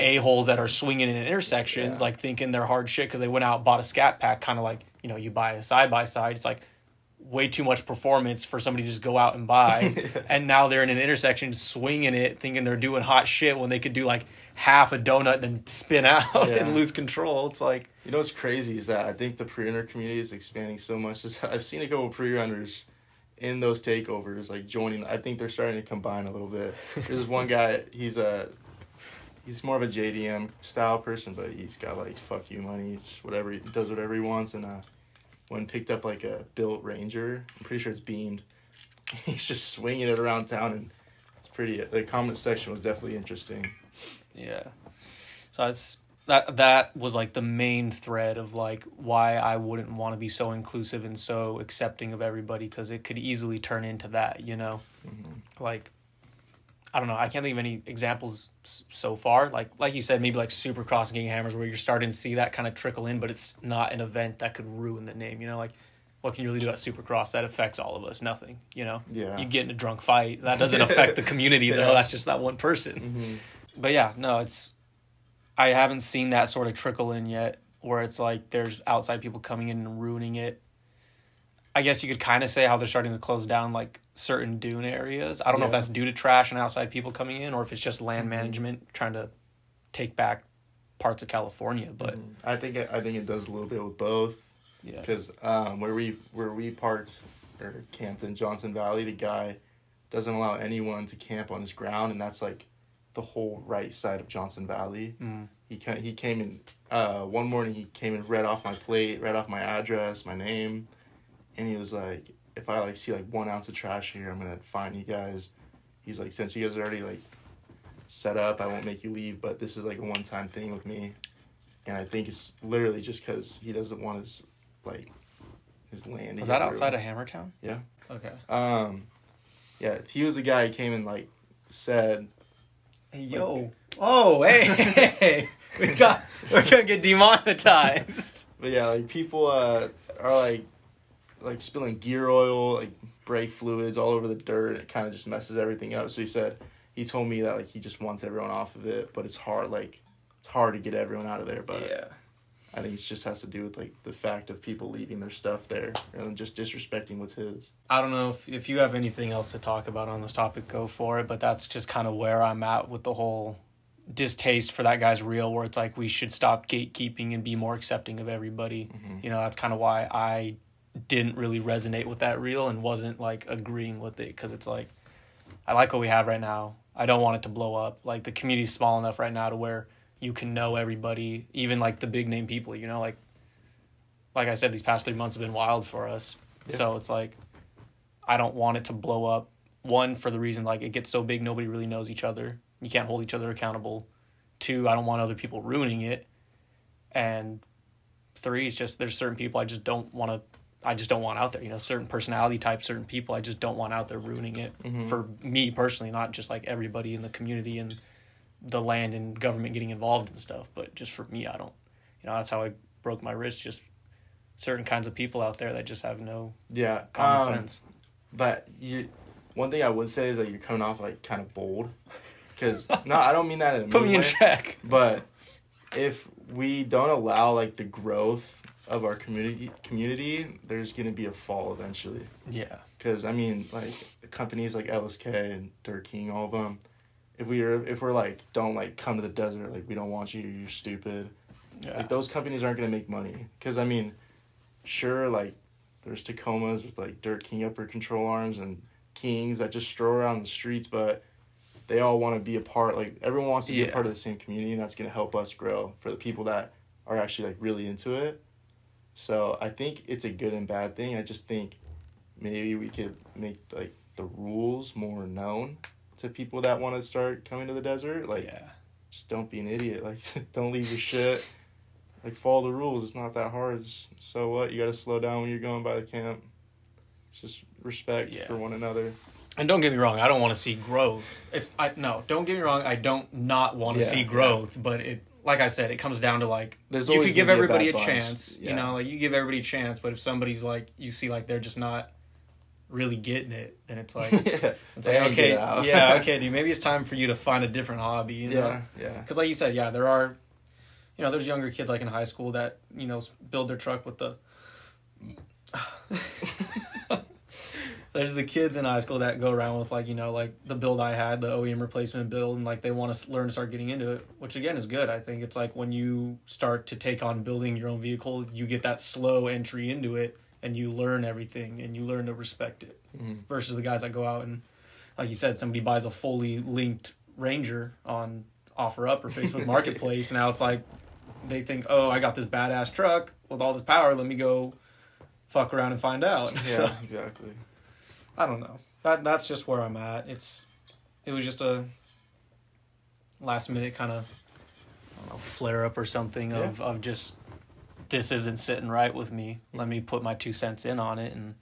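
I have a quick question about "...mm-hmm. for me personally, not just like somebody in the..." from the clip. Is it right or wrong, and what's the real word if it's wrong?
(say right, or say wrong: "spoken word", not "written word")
wrong: "everybody", not "somebody".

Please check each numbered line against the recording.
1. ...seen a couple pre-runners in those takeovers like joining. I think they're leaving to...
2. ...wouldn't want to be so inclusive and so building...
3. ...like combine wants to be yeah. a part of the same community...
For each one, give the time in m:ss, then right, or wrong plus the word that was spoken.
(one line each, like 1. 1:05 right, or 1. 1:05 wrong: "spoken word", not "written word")
1. 0:21 wrong: "starting", not "leaving"
2. 0:49 wrong: "accepting", not "building"
3. 4:12 wrong: "everyone", not "combine".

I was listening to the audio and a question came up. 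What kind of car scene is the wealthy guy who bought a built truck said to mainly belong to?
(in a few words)
JDM.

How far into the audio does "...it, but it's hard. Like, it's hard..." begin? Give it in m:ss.
2:28.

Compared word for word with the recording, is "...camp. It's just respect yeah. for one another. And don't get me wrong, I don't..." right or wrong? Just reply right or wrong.
right.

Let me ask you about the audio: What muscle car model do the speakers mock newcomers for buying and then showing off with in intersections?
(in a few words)
Scat Pack.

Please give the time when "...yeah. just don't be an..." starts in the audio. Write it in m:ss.
4:28.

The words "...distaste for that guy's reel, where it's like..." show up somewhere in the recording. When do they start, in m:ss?
2:44.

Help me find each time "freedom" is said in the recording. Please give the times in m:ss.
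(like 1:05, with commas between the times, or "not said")
not said.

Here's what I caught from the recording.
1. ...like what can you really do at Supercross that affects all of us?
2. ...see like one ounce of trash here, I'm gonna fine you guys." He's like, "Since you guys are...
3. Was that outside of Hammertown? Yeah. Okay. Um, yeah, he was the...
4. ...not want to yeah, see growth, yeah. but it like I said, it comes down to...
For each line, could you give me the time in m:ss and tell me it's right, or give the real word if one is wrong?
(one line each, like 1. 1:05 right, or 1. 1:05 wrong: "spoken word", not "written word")
1. 1:05 right
2. 1:52 right
3. 2:06 right
4. 4:43 right.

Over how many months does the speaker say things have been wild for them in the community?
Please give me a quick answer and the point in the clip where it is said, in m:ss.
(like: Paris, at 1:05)
3, at 3:05.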